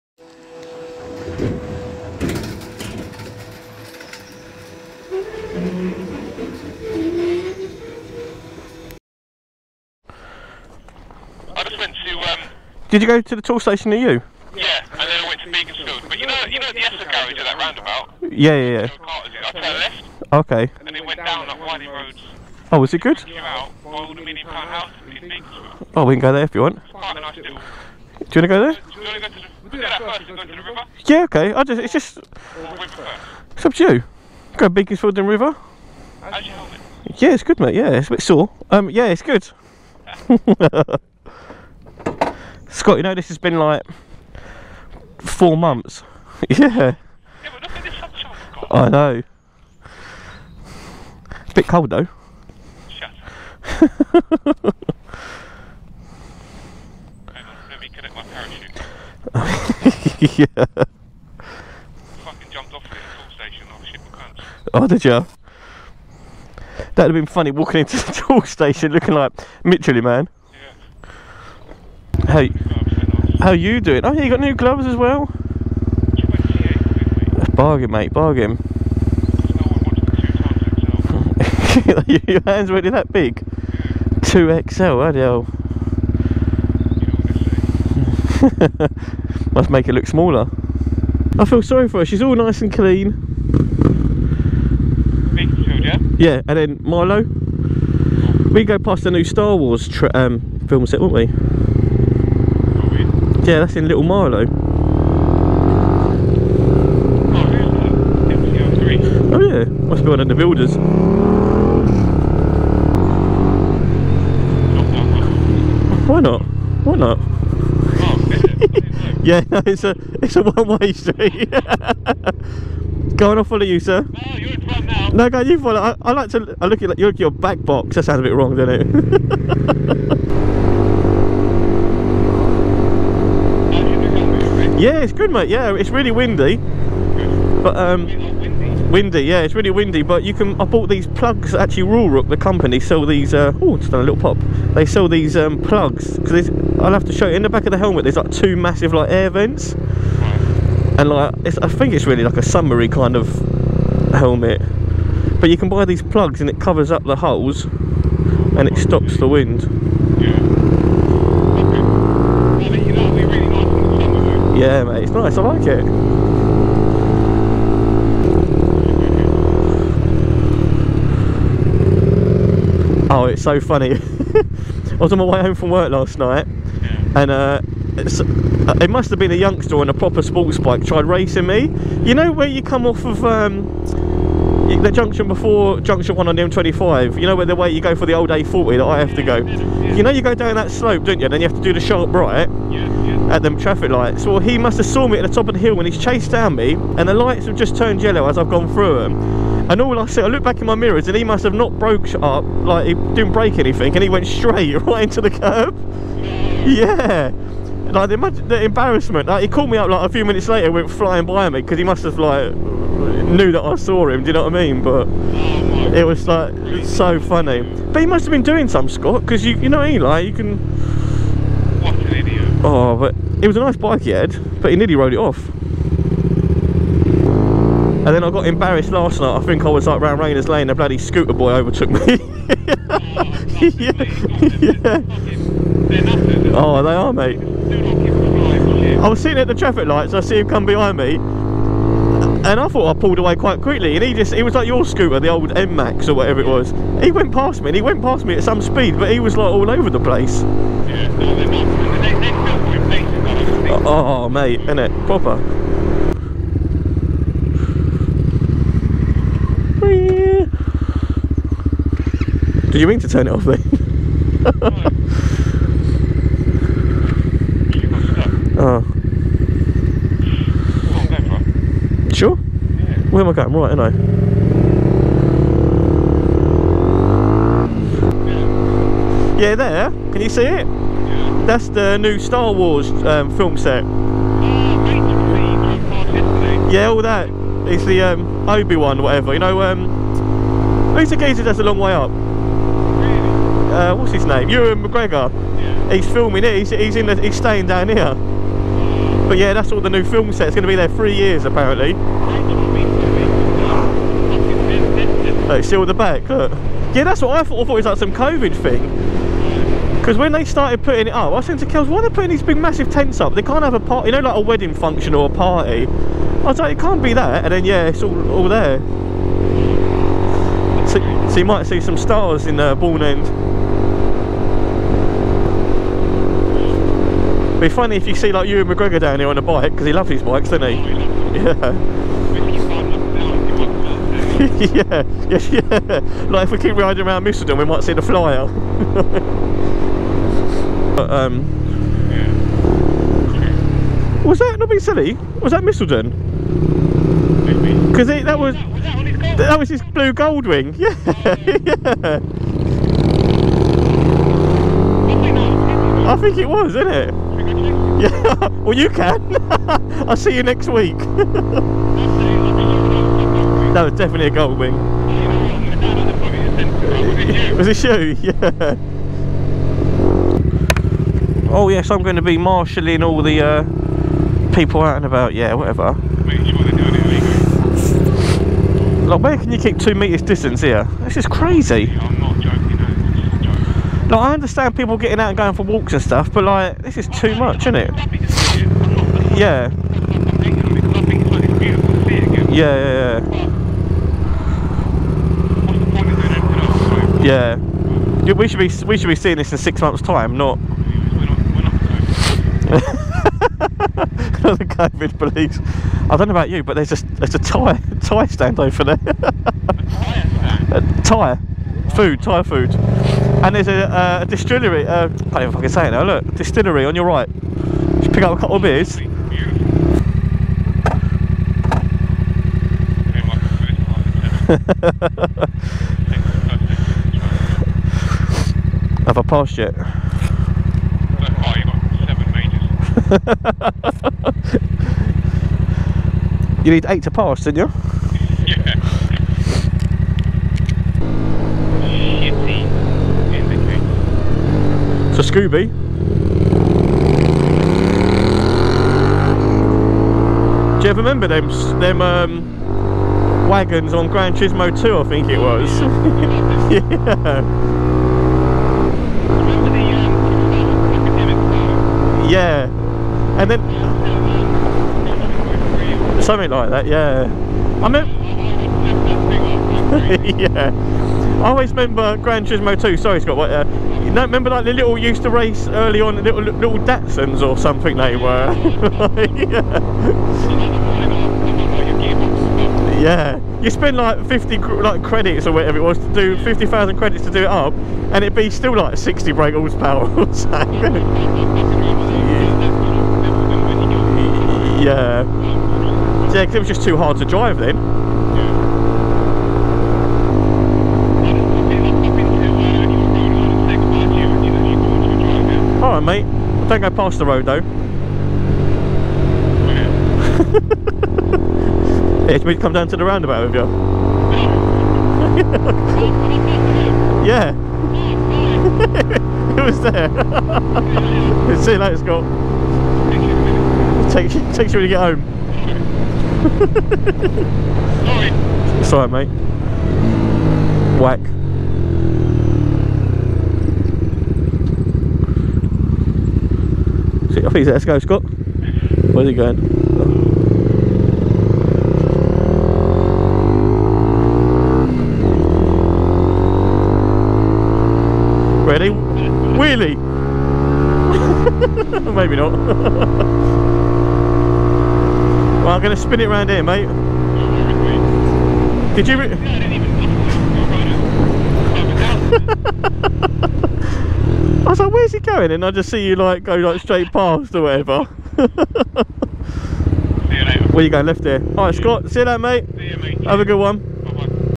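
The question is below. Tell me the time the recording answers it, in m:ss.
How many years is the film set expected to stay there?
5:00.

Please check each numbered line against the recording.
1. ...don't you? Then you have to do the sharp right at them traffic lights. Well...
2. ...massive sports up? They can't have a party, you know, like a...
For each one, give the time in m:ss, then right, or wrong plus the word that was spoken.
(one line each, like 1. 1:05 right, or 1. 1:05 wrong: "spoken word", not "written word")
1. 3:11 right
2. 5:12 wrong: "tents", not "sports".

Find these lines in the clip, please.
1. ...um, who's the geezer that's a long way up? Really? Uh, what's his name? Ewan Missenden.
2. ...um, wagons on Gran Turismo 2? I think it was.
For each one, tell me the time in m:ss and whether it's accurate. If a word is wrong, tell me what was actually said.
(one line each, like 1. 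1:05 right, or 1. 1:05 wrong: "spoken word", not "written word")
1. 4:49 wrong: "McGregor", not "Missenden"
2. 7:32 right.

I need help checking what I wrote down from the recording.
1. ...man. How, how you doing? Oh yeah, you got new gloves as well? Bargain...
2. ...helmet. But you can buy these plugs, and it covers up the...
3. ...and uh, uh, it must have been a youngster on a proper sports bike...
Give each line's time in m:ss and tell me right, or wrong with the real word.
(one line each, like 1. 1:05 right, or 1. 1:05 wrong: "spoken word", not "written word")
1. 1:10 right
2. 2:34 right
3. 2:57 right.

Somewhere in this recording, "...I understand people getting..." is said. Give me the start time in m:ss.
6:24.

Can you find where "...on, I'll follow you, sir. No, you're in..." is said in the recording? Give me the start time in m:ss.
2:03.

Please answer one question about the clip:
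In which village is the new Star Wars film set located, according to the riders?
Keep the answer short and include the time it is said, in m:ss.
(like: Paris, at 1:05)
Little Marlow, at 1:43.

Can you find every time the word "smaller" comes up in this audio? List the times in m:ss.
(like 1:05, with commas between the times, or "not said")
1:30.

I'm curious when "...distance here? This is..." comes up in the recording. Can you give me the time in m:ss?
6:20.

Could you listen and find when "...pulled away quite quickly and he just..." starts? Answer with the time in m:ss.
4:02.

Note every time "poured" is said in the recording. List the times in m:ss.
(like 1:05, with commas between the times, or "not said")
not said.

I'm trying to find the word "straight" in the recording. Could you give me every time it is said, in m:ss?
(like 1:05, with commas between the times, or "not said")
3:24, 9:26.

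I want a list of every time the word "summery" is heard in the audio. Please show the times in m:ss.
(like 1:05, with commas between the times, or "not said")
2:32.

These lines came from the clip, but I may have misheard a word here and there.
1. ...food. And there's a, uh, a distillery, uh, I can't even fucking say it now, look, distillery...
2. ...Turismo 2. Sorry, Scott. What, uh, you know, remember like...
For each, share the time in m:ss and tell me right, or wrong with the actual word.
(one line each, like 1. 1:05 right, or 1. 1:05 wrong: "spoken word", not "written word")
1. 6:52 right
2. 7:52 right.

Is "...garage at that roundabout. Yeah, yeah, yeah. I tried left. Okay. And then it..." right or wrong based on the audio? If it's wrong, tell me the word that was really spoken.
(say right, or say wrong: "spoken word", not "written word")
wrong: "turned", not "tried".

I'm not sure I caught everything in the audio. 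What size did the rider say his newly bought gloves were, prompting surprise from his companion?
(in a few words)
2XL.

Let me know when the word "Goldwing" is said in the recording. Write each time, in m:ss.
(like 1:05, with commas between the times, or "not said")
5:50, 6:04.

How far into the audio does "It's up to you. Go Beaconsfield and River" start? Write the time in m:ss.
0:33.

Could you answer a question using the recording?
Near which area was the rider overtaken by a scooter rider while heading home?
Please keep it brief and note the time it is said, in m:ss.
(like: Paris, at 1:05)
Rayners Lane, at 3:50.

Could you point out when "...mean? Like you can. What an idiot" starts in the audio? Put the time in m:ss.
3:39.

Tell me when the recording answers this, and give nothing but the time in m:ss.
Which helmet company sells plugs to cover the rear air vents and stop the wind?
2:21.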